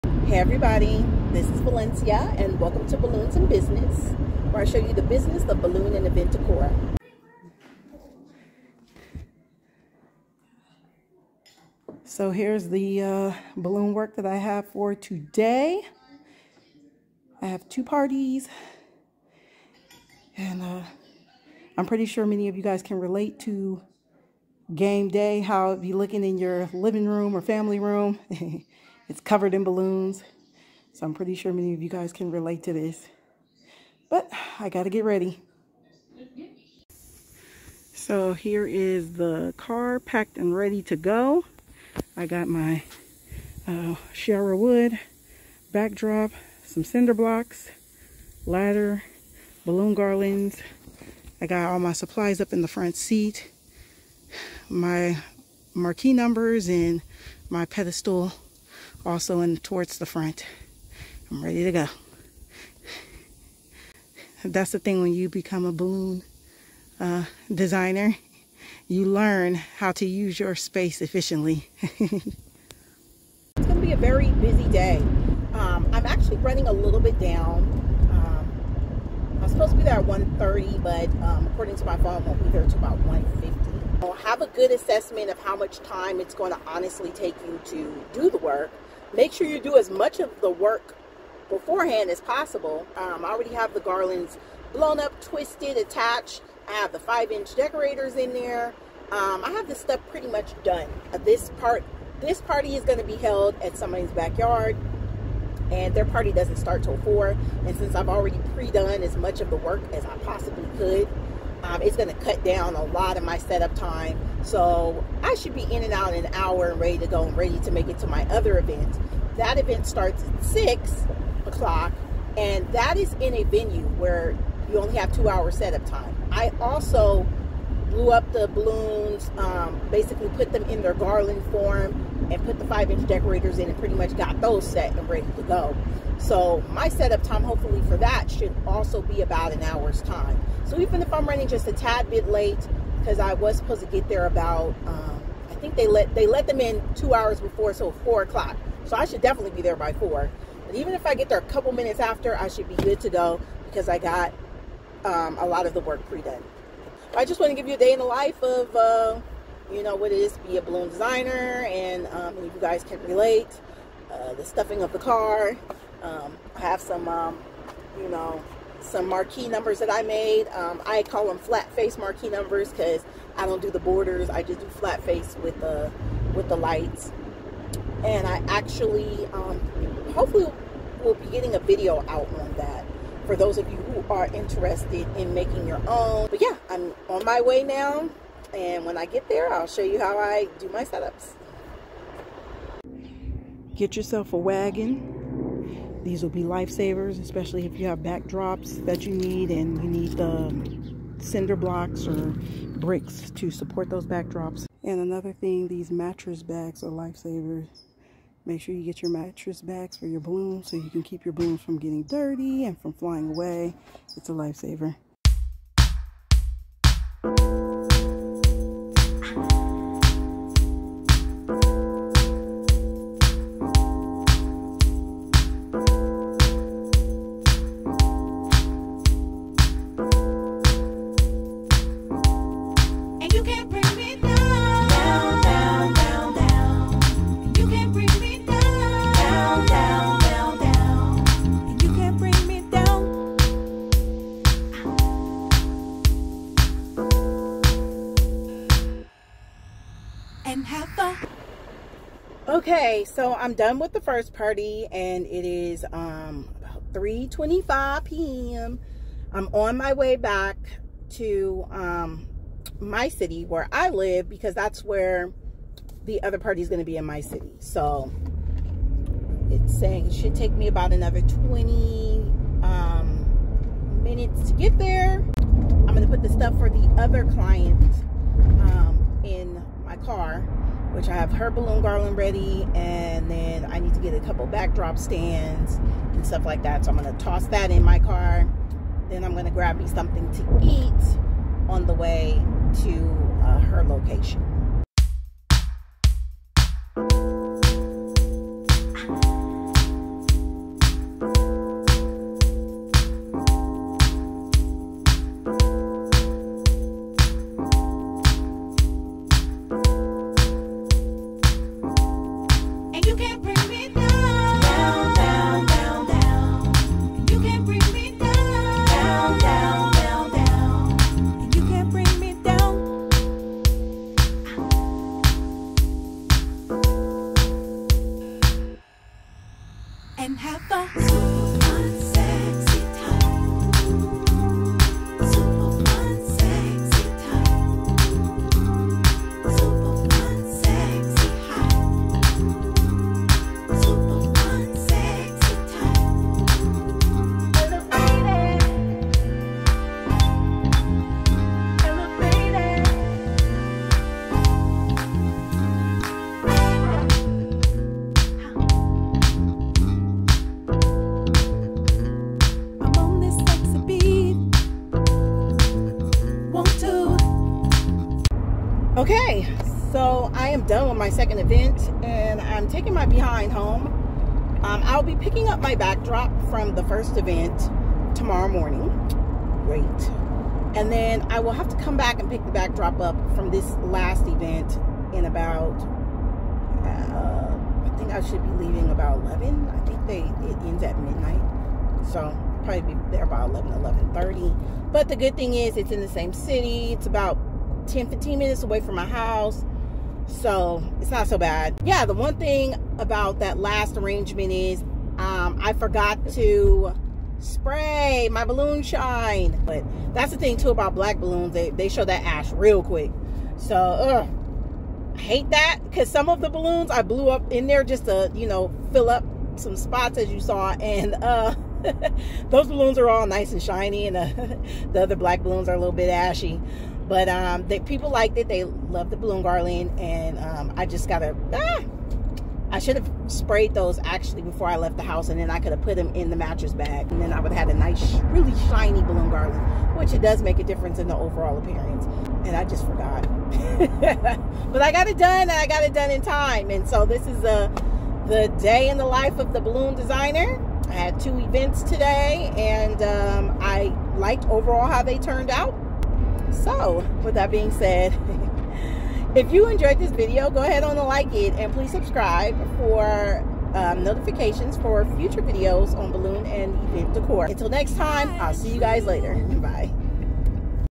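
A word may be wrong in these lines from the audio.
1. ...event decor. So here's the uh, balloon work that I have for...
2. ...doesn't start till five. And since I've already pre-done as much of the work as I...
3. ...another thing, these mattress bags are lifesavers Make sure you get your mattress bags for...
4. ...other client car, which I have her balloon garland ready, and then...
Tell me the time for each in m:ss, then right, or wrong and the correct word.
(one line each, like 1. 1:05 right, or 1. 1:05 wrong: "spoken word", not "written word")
1. 0:06 right
2. 1:46 wrong: "four", not "five"
3. 3:24 right
4. 4:36 right.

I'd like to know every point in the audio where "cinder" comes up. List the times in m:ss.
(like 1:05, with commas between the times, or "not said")
0:46, 3:21.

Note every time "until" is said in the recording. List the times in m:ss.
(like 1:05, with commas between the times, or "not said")
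1:22, 7:47.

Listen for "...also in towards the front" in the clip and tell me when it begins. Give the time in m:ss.
0:59.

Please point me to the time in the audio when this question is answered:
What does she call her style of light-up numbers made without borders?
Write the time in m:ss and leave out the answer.
2:51.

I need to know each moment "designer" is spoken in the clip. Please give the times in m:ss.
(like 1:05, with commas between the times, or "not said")
1:07, 2:40, 7:29.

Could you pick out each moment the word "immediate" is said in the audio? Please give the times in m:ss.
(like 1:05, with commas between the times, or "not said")
not said.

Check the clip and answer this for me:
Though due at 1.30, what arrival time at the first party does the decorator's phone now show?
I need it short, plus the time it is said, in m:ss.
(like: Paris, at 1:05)
1:50, at 1:23.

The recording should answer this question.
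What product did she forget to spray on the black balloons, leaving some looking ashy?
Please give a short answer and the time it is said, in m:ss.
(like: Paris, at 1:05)
balloon shine, at 6:48.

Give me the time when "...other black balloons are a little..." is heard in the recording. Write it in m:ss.
7:05.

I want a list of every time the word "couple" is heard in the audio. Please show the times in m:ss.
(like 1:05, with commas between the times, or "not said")
2:31, 4:44.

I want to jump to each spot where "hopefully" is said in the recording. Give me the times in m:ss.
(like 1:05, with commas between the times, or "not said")
2:17, 3:00.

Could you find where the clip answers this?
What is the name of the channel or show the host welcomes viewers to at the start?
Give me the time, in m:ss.
0:02.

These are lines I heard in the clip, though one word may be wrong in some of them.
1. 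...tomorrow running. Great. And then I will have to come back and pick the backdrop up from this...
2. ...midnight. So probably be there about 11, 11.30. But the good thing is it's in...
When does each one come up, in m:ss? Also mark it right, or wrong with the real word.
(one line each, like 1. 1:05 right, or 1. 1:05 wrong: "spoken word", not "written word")
1. 6:18 wrong: "morning", not "running"
2. 6:30 right.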